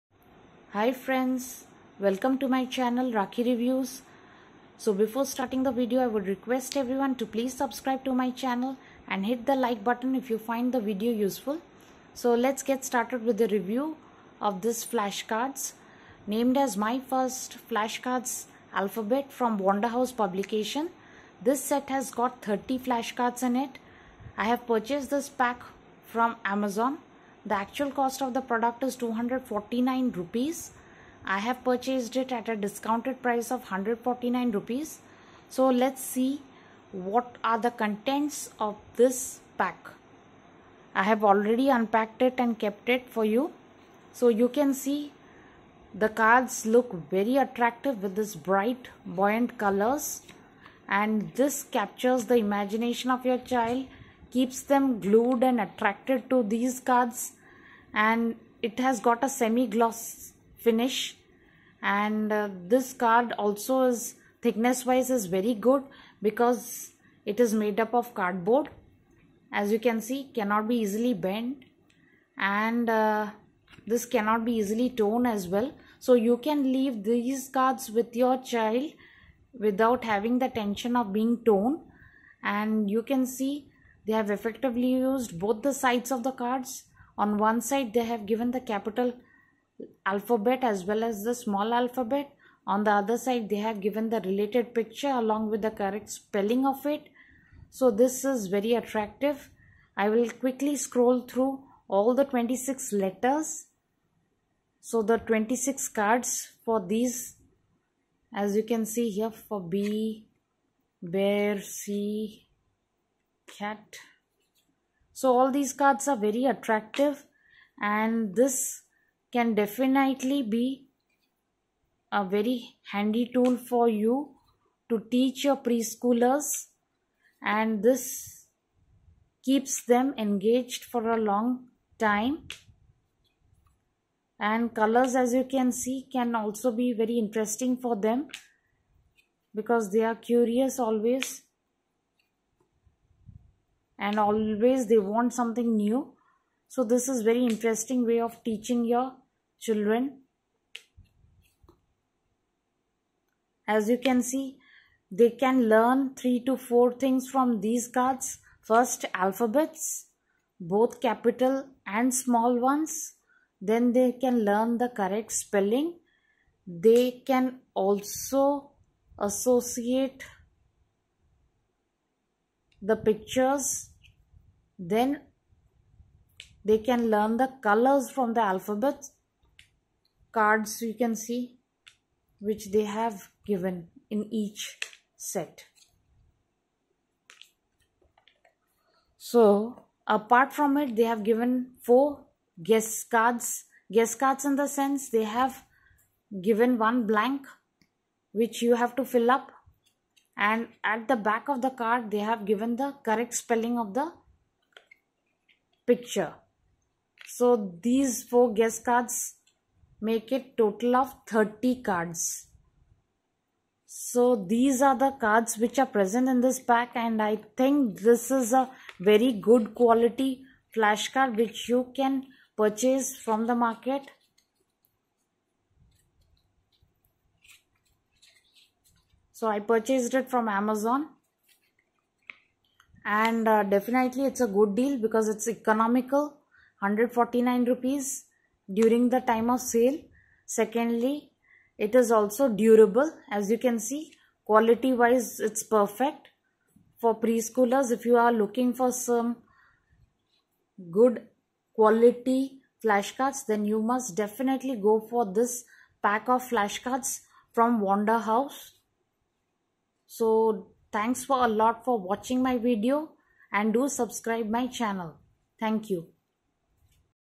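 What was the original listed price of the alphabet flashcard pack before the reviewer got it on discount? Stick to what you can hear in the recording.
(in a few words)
249 rupees.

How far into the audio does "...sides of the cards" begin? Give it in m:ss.
1:25.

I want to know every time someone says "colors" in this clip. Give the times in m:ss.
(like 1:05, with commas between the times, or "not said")
0:49, 2:14, 2:57.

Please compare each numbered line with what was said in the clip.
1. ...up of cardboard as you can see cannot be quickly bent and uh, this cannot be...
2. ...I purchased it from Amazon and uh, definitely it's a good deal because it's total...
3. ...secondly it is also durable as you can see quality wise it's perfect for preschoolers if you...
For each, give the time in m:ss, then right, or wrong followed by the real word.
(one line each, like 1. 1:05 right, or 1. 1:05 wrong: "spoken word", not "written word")
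1. 1:07 wrong: "easily", not "quickly"
2. 3:49 wrong: "economical", not "total"
3. 4:00 right.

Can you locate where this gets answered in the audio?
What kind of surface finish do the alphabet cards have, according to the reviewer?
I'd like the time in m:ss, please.
0:59.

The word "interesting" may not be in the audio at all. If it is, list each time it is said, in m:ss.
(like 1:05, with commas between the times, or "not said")
2:17, 2:27.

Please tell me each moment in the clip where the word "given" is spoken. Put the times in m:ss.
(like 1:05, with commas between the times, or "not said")
1:28, 1:33, 3:03, 3:11, 3:16, 3:22.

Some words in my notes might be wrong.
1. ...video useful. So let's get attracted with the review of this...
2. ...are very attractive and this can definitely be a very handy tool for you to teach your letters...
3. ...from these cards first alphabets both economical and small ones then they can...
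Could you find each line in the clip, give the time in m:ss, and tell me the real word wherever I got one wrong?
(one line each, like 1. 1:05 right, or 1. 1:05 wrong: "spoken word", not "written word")
1. 0:10 wrong: "started", not "attracted"
2. 1:56 wrong: "preschoolers", not "letters"
3. 2:37 wrong: "capital", not "economical".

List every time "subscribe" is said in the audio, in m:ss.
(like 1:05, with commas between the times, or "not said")
0:07, 4:23.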